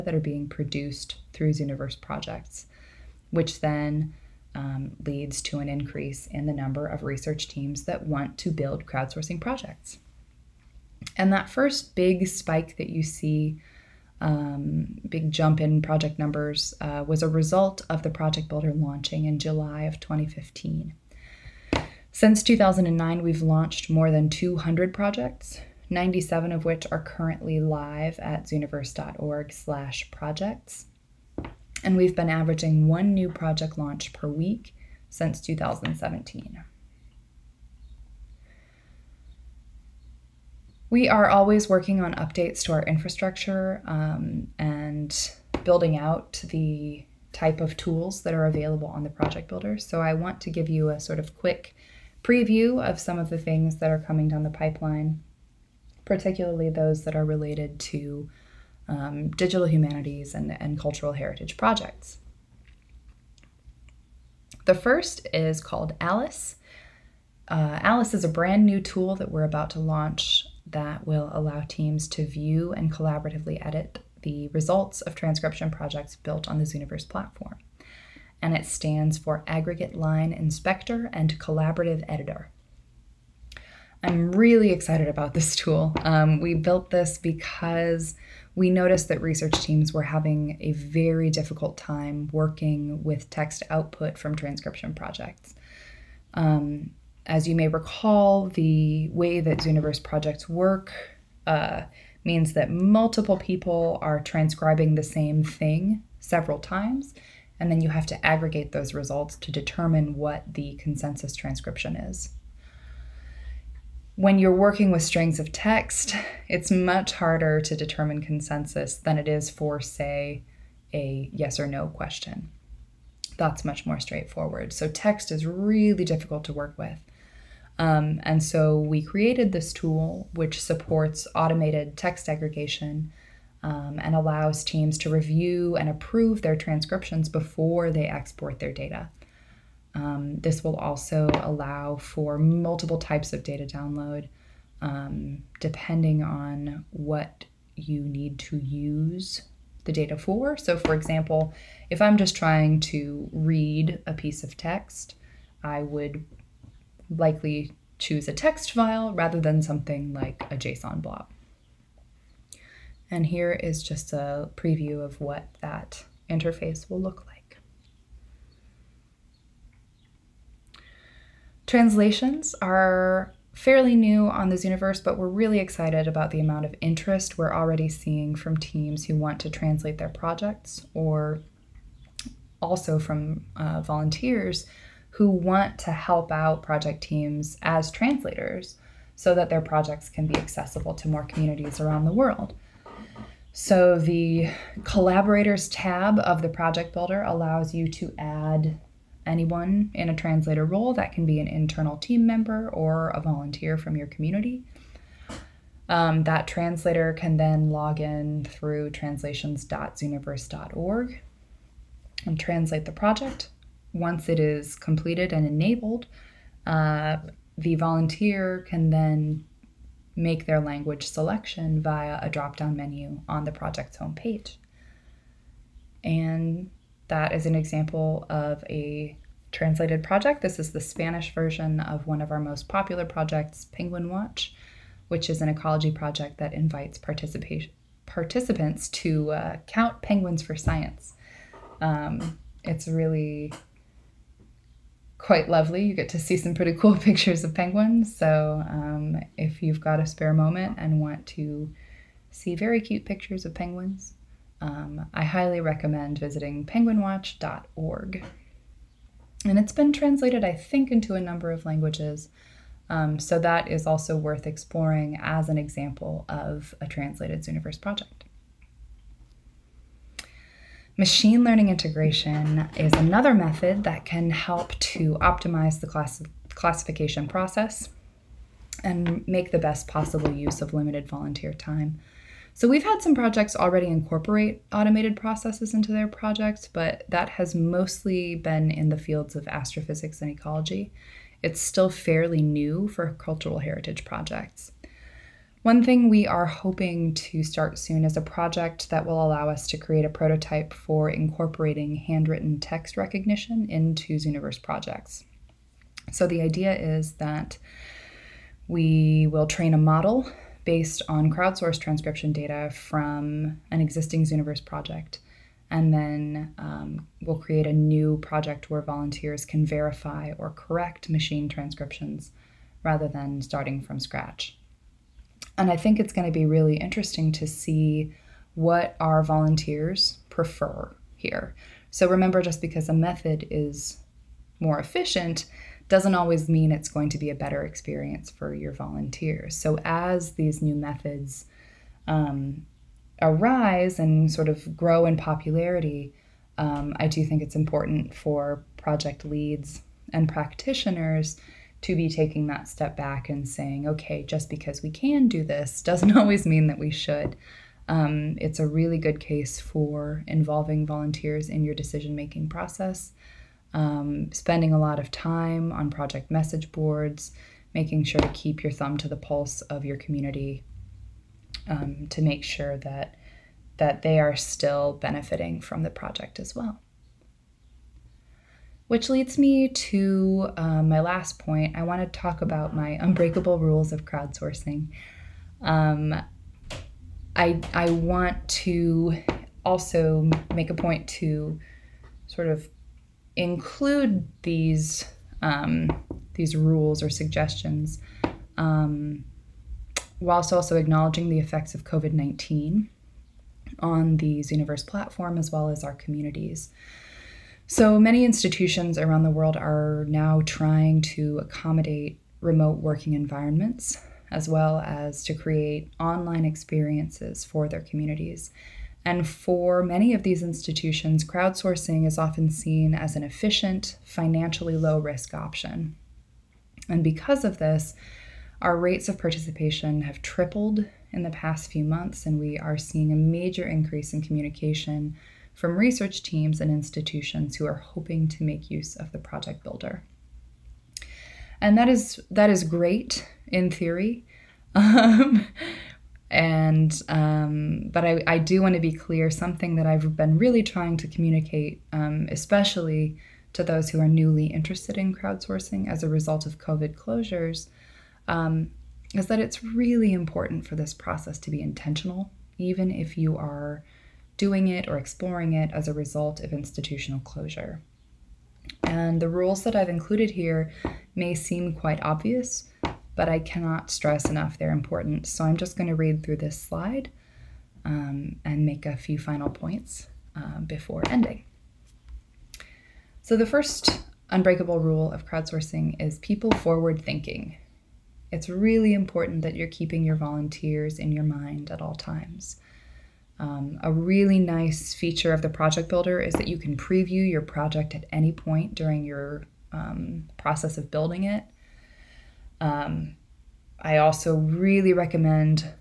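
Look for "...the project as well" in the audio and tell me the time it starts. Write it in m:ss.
6:15.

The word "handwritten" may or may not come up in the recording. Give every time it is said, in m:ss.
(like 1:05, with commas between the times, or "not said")
5:01.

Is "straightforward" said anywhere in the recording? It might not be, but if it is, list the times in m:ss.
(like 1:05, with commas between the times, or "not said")
2:03.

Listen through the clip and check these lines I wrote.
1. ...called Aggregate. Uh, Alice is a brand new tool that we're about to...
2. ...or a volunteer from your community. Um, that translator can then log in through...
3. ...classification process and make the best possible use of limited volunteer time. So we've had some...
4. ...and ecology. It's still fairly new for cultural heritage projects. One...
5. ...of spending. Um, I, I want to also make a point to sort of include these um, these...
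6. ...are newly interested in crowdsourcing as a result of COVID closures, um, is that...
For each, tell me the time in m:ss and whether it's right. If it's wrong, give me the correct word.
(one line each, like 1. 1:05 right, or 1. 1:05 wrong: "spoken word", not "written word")
1. 1:05 wrong: "Alice", not "Aggregate"
2. 3:22 right
3. 4:36 right
4. 4:50 right
5. 6:23 wrong: "crowdsourcing", not "spending"
6. 7:34 right.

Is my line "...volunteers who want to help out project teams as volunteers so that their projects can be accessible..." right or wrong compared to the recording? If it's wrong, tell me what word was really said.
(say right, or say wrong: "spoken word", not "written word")
wrong: "translators", not "volunteers".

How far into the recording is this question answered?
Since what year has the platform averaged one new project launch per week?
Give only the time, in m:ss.
0:35.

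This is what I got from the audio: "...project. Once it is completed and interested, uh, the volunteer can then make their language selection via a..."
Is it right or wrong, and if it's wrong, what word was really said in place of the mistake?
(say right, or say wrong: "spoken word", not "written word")
wrong: "enabled", not "interested".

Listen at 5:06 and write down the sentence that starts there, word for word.
So the idea is that we will train a model based on crowdsourced transcription data from an existing Zooniverse project.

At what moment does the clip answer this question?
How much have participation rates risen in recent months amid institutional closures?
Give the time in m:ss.
7:10.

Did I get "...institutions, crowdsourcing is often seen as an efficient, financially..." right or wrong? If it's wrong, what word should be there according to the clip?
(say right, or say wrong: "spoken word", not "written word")
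right.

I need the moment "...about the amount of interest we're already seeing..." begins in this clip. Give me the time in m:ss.
2:56.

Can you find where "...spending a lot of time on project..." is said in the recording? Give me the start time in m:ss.
6:04.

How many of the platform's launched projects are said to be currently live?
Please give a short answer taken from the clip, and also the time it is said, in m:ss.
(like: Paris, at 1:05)
97, at 0:25.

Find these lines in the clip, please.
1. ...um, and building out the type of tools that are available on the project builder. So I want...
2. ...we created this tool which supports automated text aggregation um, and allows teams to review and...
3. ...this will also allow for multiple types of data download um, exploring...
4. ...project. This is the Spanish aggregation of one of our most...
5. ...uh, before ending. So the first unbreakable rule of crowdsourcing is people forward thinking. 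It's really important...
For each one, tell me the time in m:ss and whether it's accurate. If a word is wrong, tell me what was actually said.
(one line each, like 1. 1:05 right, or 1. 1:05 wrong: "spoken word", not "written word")
1. 0:43 right
2. 2:08 right
3. 2:20 wrong: "depending", not "exploring"
4. 3:50 wrong: "version", not "aggregation"
5. 8:00 right.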